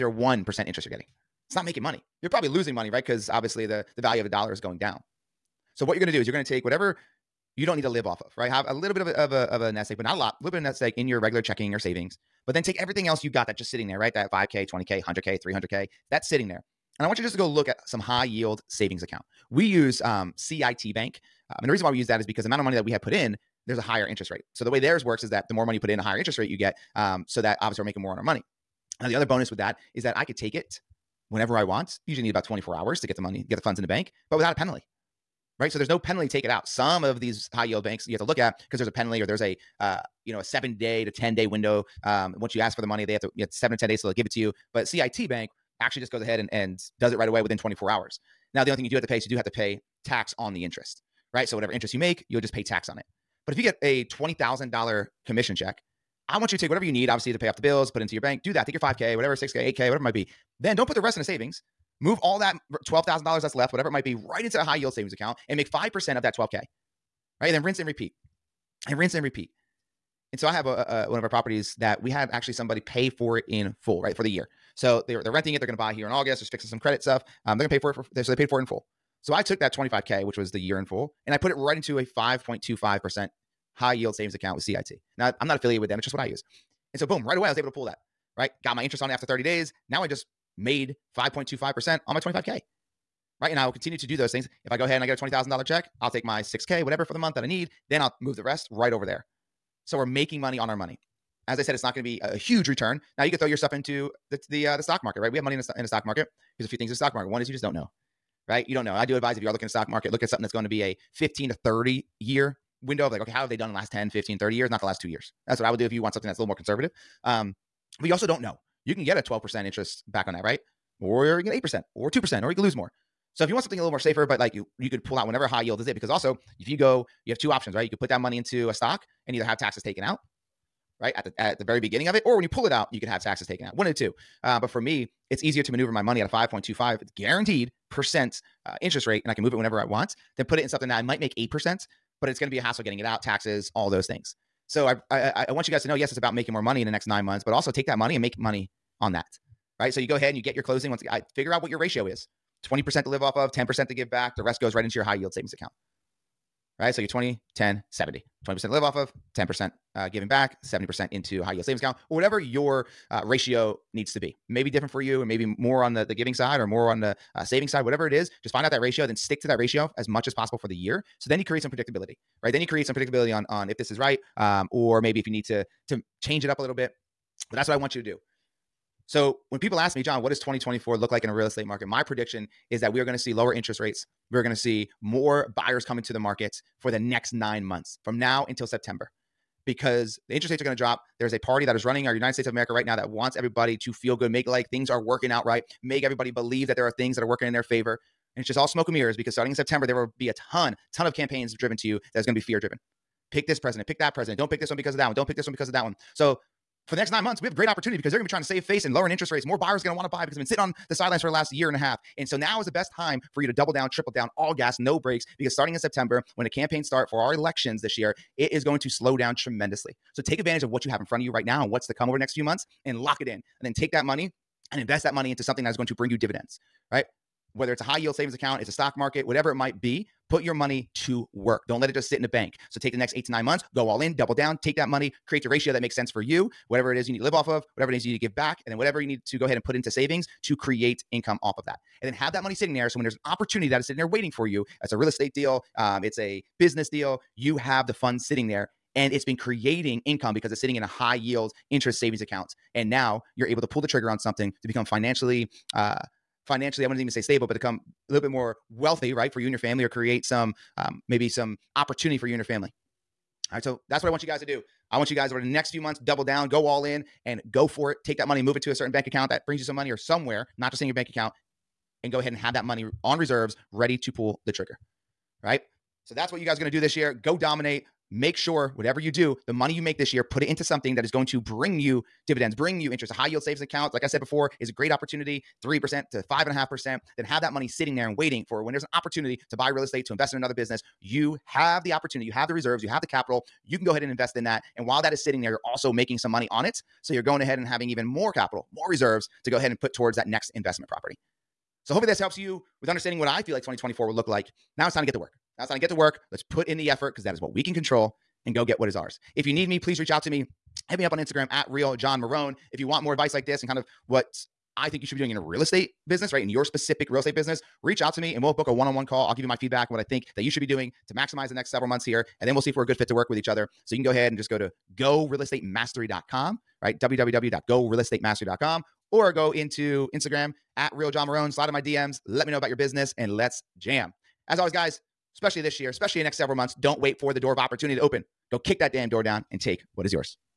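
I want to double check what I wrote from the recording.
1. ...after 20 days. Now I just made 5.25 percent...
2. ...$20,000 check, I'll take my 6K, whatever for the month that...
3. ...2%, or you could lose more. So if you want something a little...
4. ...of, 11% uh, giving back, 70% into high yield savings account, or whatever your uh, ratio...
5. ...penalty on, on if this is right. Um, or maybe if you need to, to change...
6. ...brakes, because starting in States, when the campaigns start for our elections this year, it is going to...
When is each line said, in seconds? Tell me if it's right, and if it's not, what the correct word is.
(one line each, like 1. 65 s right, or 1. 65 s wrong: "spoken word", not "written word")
1. 89 s wrong: "30", not "20"
2. 95 s right
3. 122 s right
4. 158 s wrong: "10", not "11"
5. 172 s wrong: "predictability", not "penalty"
6. 214 s wrong: "September", not "States".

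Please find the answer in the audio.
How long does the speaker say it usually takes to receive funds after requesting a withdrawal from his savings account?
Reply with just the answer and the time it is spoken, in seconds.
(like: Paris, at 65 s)
24 hours, at 32 s.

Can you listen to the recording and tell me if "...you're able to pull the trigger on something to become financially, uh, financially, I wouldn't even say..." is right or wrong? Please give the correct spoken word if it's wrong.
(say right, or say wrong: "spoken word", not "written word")
right.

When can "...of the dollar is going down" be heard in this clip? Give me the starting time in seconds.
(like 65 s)
4 s.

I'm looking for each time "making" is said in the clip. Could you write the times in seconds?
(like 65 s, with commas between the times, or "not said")
1 s, 27 s, 100 s, 146 s, 295 s.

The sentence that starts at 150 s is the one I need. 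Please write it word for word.
Once I figure out what your ratio is 20% to live off of, 10% to give back.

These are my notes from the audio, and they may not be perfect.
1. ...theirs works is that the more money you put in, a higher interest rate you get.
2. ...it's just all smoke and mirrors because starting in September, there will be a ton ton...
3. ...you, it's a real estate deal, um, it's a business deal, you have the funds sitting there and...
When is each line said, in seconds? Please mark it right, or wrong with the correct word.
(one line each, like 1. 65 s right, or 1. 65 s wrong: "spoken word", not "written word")
1. 24 s right
2. 198 s right
3. 244 s right.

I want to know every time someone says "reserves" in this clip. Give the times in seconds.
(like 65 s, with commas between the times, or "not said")
273 s, 292 s, 298 s.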